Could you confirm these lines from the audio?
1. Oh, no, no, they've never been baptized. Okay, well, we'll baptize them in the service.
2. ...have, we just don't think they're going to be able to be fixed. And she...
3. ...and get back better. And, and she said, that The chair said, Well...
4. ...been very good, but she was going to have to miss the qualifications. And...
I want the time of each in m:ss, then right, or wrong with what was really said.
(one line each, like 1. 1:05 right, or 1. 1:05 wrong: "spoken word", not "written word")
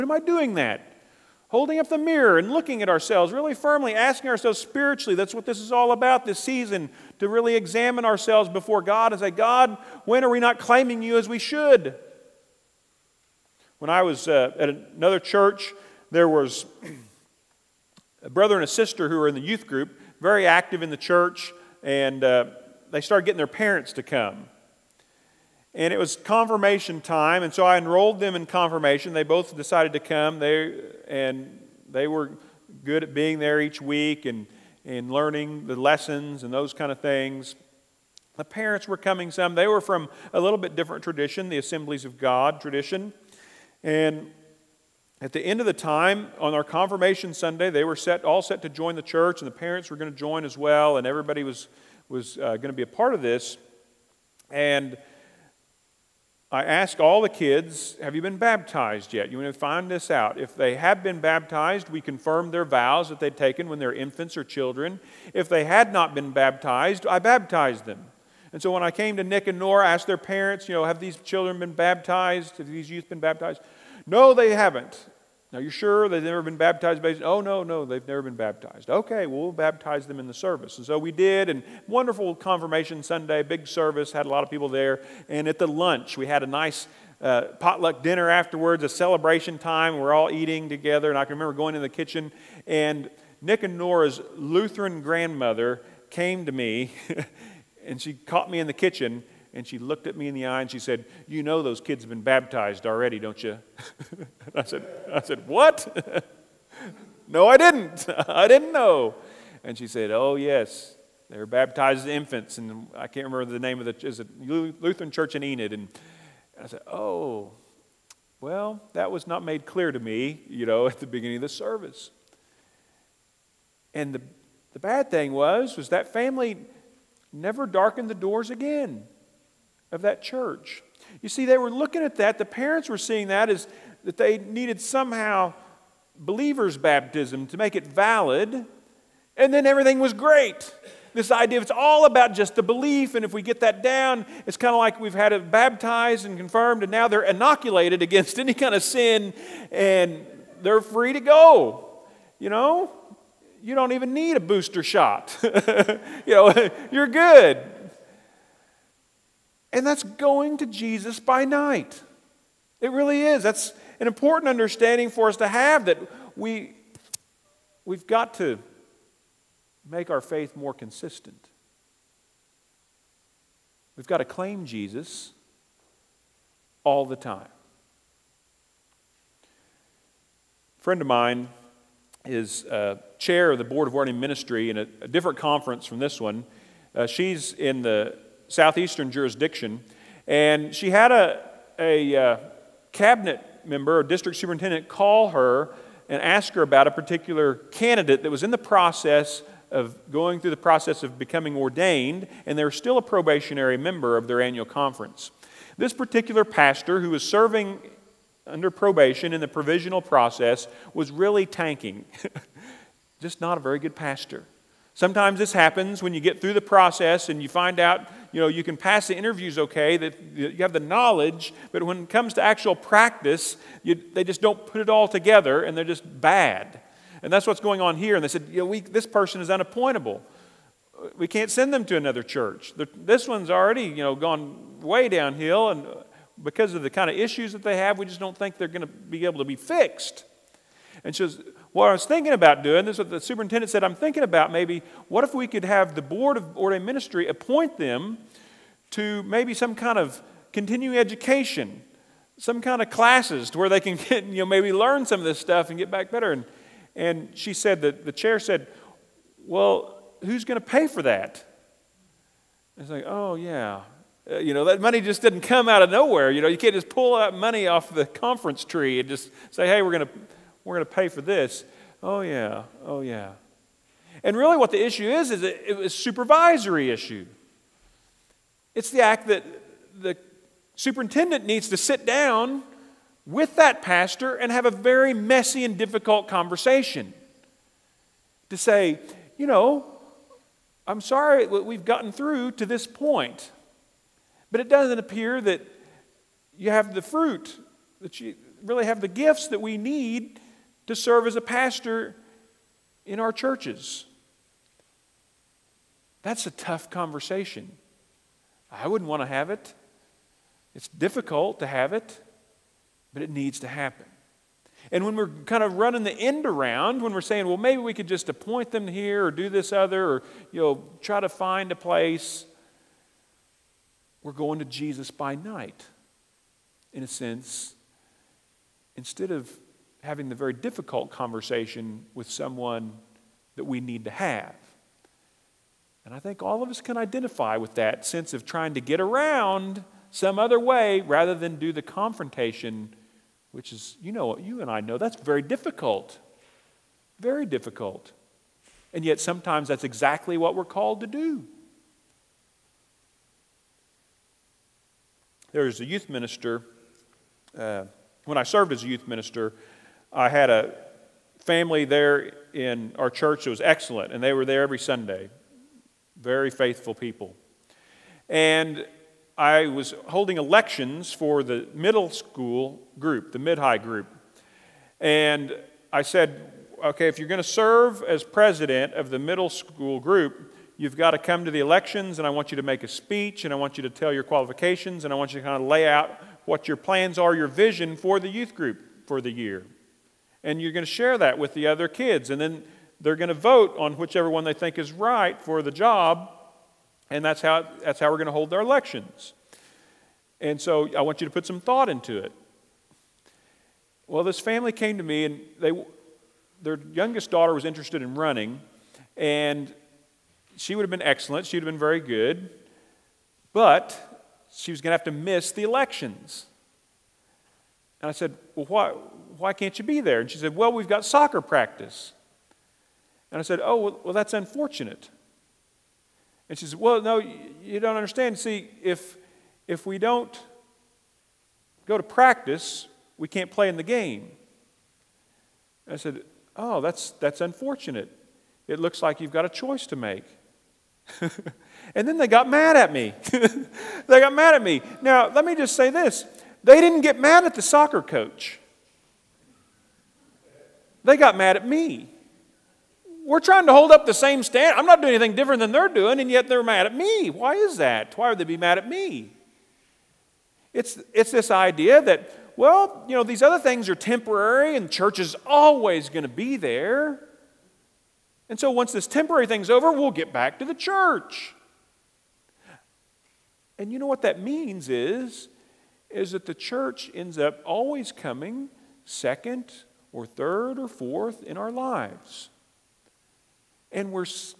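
1. 1:17 right
2. 3:57 right
3. 4:15 right
4. 6:51 wrong: "elections", not "qualifications".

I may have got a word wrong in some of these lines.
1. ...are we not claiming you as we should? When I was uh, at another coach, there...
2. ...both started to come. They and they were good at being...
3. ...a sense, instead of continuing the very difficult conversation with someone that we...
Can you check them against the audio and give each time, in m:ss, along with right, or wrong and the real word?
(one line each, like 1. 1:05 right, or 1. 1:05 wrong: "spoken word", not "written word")
1. 0:10 wrong: "church", not "coach"
2. 0:29 wrong: "decided", not "started"
3. 5:27 wrong: "having", not "continuing".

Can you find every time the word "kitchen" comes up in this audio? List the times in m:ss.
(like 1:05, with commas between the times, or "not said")
1:31, 1:38.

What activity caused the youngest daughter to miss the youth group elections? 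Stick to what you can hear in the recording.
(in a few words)
soccer practice.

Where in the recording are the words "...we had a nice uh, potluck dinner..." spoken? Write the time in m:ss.
1:26.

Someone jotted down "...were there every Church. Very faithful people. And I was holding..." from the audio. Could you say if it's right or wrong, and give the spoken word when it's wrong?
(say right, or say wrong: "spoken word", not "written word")
wrong: "Sunday", not "Church".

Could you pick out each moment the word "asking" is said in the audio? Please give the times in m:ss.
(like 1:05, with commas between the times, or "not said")
0:03.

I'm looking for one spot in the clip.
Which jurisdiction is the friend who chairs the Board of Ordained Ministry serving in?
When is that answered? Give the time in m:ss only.
3:08.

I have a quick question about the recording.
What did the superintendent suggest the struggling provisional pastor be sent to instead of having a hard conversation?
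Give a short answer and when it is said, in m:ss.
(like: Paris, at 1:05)
continuing education, at 4:10.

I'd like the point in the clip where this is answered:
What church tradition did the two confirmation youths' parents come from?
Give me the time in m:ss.
0:41.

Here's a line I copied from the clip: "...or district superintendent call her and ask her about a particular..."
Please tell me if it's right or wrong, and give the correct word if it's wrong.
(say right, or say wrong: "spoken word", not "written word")
right.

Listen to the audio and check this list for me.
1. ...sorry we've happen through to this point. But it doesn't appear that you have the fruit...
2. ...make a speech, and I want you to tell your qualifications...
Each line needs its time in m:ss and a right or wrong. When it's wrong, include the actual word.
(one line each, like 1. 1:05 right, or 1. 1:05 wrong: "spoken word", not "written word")
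1. 4:51 wrong: "gotten", not "happen"
2. 6:22 right.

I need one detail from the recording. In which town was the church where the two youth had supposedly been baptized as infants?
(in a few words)
Enid.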